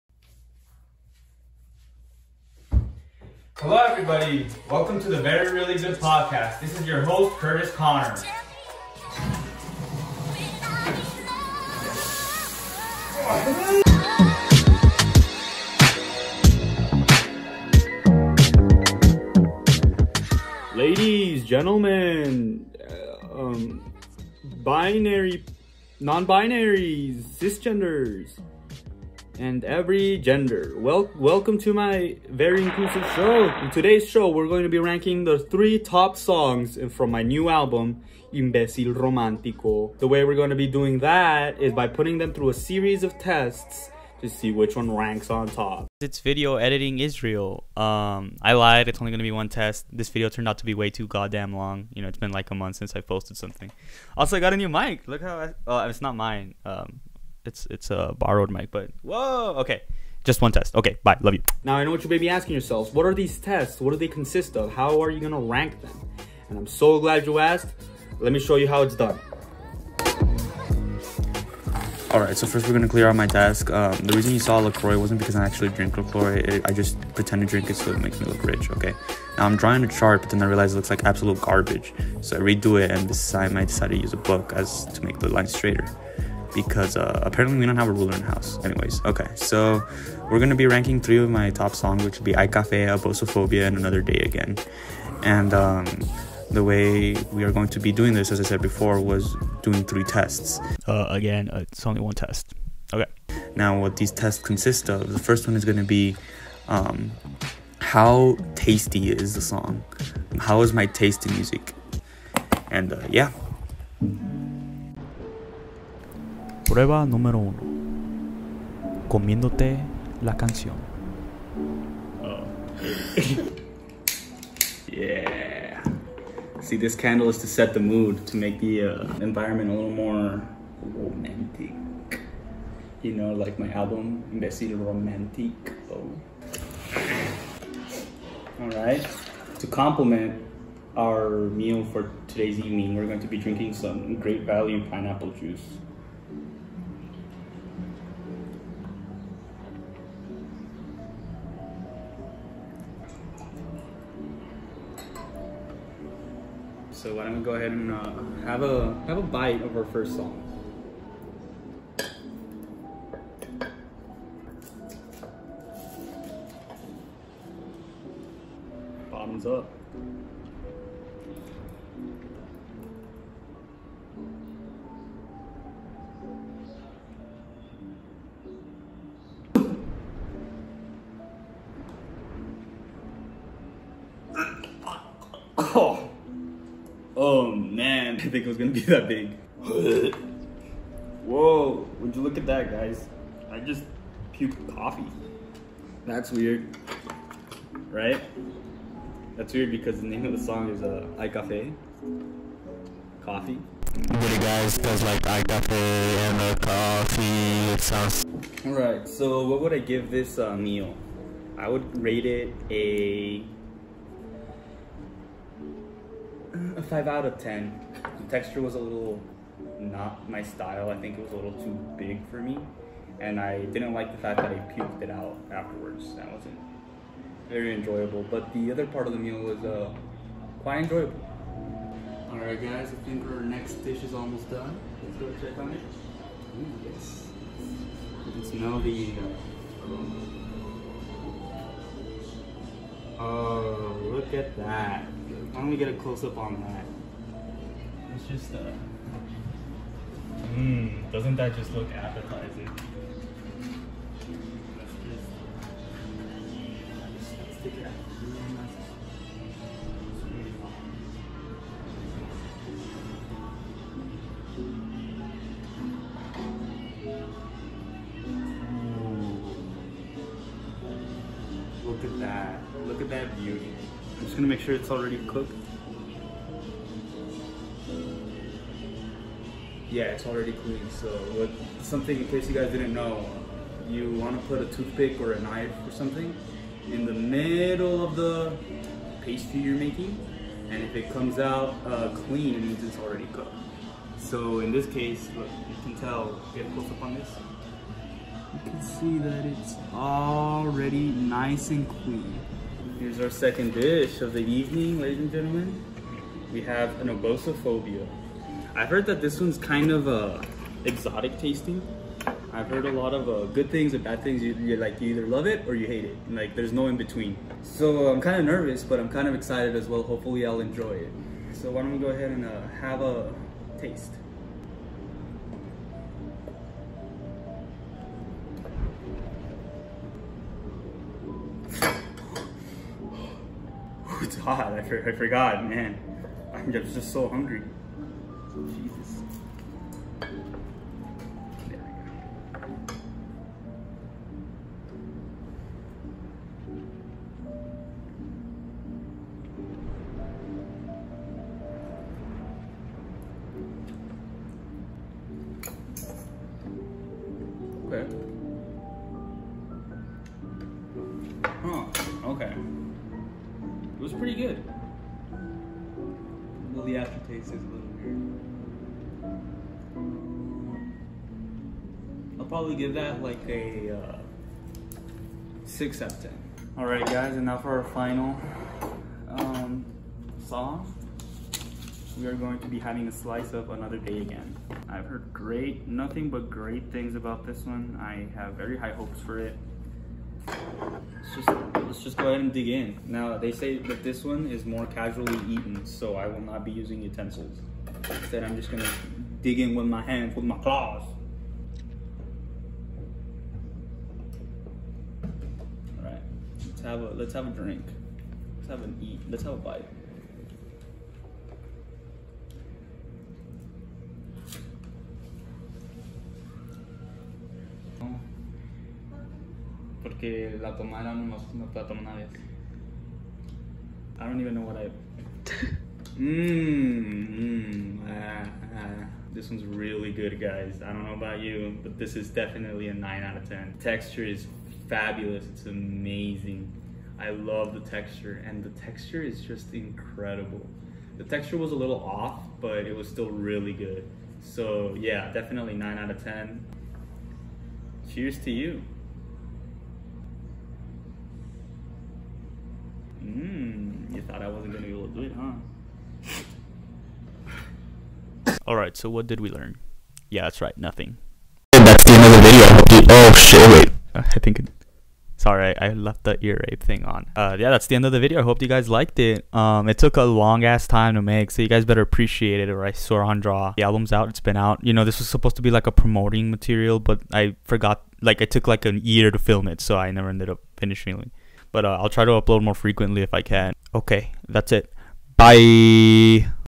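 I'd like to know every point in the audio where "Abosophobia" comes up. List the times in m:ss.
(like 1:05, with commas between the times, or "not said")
1:32.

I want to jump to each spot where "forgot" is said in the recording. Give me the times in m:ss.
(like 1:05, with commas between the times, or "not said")
5:35, 7:57.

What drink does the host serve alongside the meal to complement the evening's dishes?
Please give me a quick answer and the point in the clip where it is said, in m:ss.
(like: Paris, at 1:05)
pineapple juice, at 2:24.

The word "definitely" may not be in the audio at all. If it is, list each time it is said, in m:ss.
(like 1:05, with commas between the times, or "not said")
7:12, 7:25.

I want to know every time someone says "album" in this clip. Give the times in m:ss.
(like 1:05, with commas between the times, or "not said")
0:37, 2:13, 7:53.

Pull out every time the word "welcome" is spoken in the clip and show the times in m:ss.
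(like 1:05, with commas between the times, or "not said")
0:04, 0:31.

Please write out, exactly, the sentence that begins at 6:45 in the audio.
All right, let's have a, let's have a drink.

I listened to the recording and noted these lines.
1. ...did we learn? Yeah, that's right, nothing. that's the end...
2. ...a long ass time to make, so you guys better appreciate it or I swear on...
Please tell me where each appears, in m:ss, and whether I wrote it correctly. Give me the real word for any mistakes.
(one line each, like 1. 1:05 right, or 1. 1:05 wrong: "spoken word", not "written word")
1. 7:39 right
2. 7:50 right.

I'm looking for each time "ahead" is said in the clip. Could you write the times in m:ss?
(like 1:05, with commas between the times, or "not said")
2:37, 5:22, 6:32.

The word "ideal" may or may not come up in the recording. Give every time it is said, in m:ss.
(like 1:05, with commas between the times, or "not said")
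not said.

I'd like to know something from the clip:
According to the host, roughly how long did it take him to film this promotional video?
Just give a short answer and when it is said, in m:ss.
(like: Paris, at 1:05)
a year, at 7:58.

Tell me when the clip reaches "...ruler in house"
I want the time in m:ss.
1:27.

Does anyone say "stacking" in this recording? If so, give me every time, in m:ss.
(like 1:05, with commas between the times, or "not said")
not said.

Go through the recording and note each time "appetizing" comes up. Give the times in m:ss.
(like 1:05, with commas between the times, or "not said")
4:11.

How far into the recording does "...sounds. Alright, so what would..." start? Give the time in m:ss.
3:27.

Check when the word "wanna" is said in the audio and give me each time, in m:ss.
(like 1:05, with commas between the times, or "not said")
4:44.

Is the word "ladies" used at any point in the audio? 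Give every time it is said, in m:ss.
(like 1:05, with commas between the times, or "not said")
0:20, 5:05.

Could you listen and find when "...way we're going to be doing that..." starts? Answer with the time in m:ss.
0:40.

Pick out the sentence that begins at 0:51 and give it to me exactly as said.
You know, it's been like a month since I posted something.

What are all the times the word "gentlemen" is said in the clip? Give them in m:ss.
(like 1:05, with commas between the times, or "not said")
0:21, 5:05.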